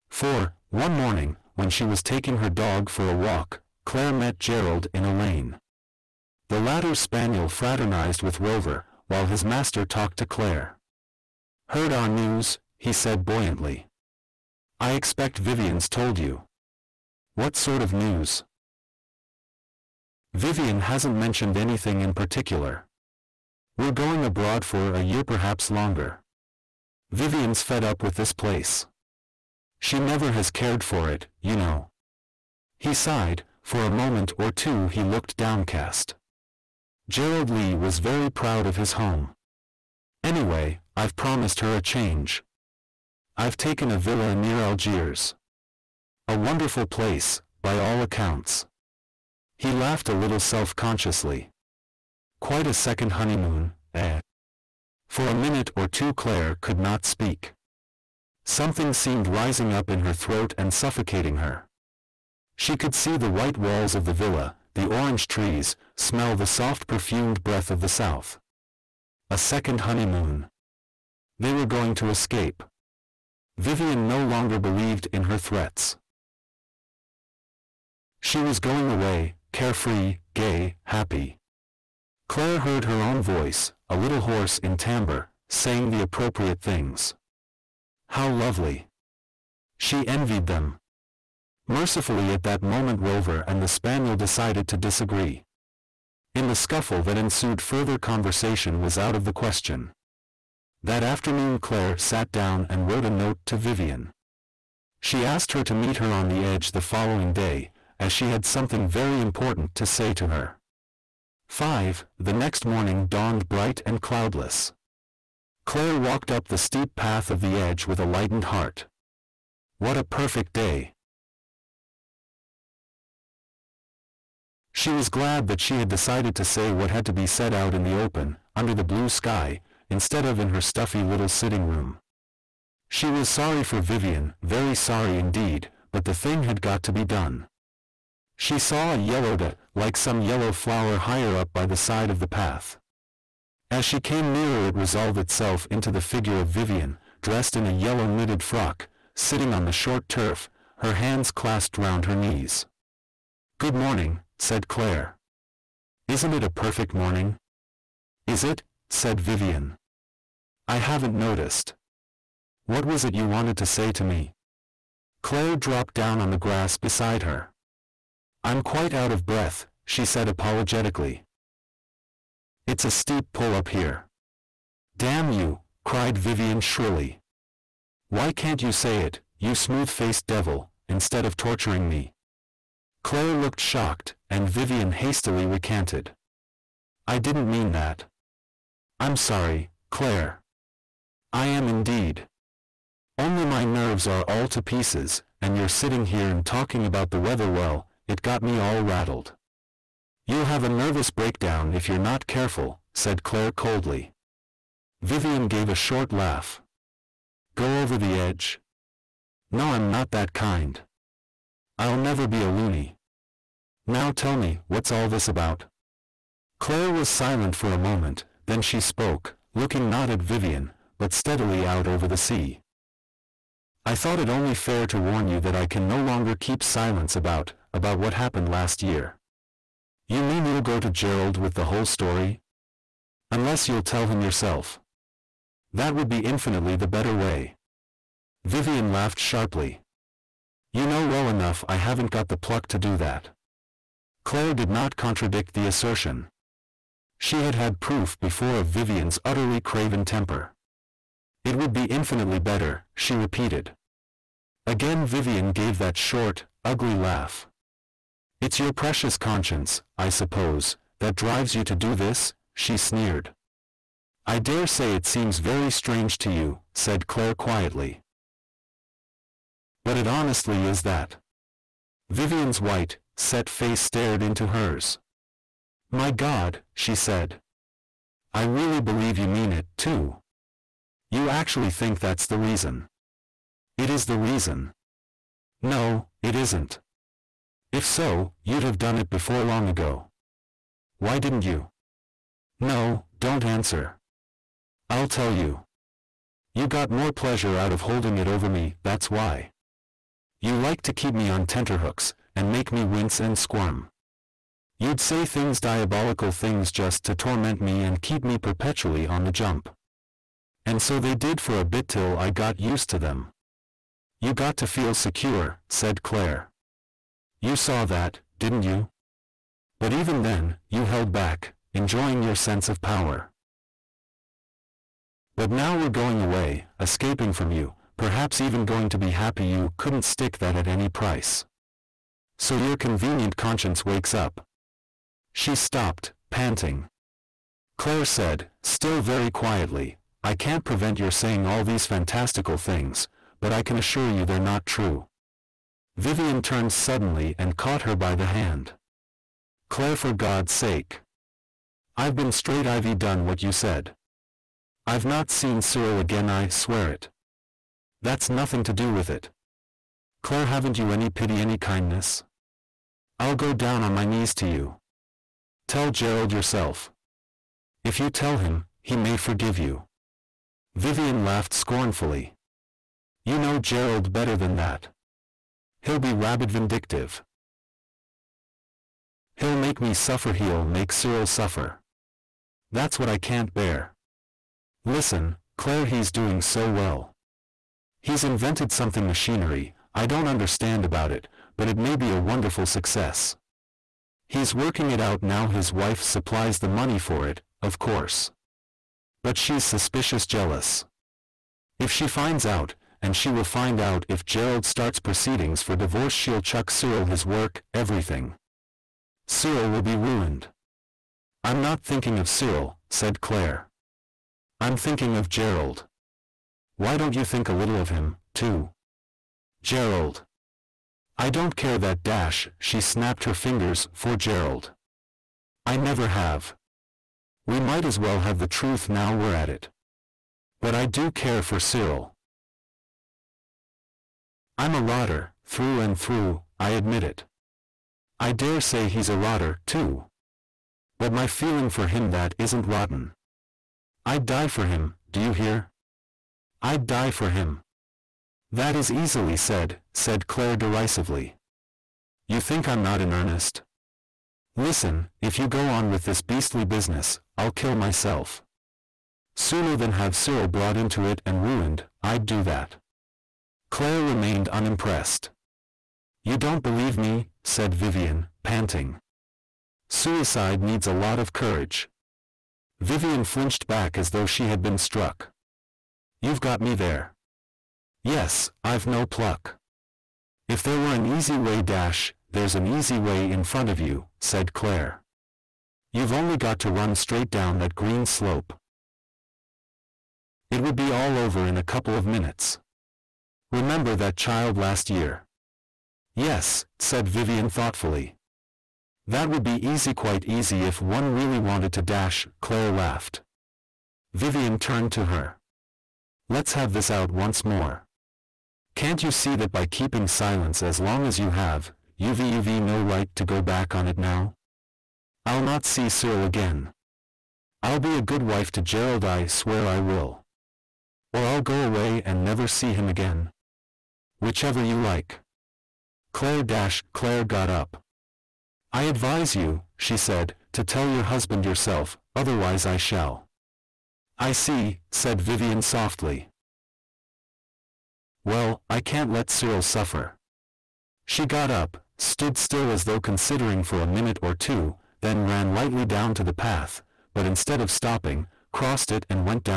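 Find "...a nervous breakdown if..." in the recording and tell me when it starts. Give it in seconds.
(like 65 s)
200 s.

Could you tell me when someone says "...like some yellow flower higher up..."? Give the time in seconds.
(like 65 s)
139 s.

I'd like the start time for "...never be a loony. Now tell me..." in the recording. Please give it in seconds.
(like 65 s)
211 s.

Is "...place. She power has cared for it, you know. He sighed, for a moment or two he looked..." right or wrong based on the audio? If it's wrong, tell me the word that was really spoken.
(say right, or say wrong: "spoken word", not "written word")
wrong: "never", not "power".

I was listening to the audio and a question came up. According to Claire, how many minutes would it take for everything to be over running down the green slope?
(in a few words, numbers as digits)
2.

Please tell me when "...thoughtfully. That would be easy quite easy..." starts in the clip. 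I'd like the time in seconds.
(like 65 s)
497 s.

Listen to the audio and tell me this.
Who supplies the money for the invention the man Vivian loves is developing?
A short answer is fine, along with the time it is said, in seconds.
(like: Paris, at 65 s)
his wife, at 395 s.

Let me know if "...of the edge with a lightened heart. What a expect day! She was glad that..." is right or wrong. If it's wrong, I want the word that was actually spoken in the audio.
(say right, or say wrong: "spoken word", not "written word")
wrong: "perfect", not "expect".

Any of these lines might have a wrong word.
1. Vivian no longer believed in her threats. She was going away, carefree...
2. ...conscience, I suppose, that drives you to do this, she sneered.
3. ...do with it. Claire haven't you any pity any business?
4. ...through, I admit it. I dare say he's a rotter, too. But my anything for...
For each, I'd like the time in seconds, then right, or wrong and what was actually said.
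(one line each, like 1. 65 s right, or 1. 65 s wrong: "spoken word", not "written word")
1. 73 s right
2. 259 s right
3. 358 s wrong: "kindness", not "business"
4. 435 s wrong: "feeling", not "anything".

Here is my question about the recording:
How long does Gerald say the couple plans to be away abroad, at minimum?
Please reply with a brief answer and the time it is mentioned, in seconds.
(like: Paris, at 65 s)
a year, at 24 s.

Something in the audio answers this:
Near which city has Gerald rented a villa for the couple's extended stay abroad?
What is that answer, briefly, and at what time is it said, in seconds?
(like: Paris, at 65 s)
Algiers, at 44 s.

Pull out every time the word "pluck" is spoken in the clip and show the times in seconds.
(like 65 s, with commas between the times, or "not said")
242 s, 479 s.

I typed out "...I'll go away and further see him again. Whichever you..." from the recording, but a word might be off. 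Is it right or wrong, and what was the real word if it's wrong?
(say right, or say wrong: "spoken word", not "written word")
wrong: "never", not "further".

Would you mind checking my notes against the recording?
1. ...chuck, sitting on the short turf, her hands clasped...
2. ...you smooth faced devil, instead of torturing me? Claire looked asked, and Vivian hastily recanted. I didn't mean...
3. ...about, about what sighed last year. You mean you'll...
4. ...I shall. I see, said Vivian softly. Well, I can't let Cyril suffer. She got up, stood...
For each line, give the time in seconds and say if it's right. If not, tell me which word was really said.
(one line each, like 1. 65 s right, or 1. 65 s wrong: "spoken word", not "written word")
1. 148 s wrong: "frock", not "chuck"
2. 179 s wrong: "shocked", not "asked"
3. 227 s wrong: "happened", not "sighed"
4. 532 s right.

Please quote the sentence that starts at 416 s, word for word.
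Why don't you think a little of him, too?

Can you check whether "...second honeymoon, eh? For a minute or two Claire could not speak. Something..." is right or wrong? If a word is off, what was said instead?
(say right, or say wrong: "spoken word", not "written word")
right.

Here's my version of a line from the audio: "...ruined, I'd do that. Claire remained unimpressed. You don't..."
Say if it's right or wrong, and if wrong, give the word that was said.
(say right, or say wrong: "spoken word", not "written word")
right.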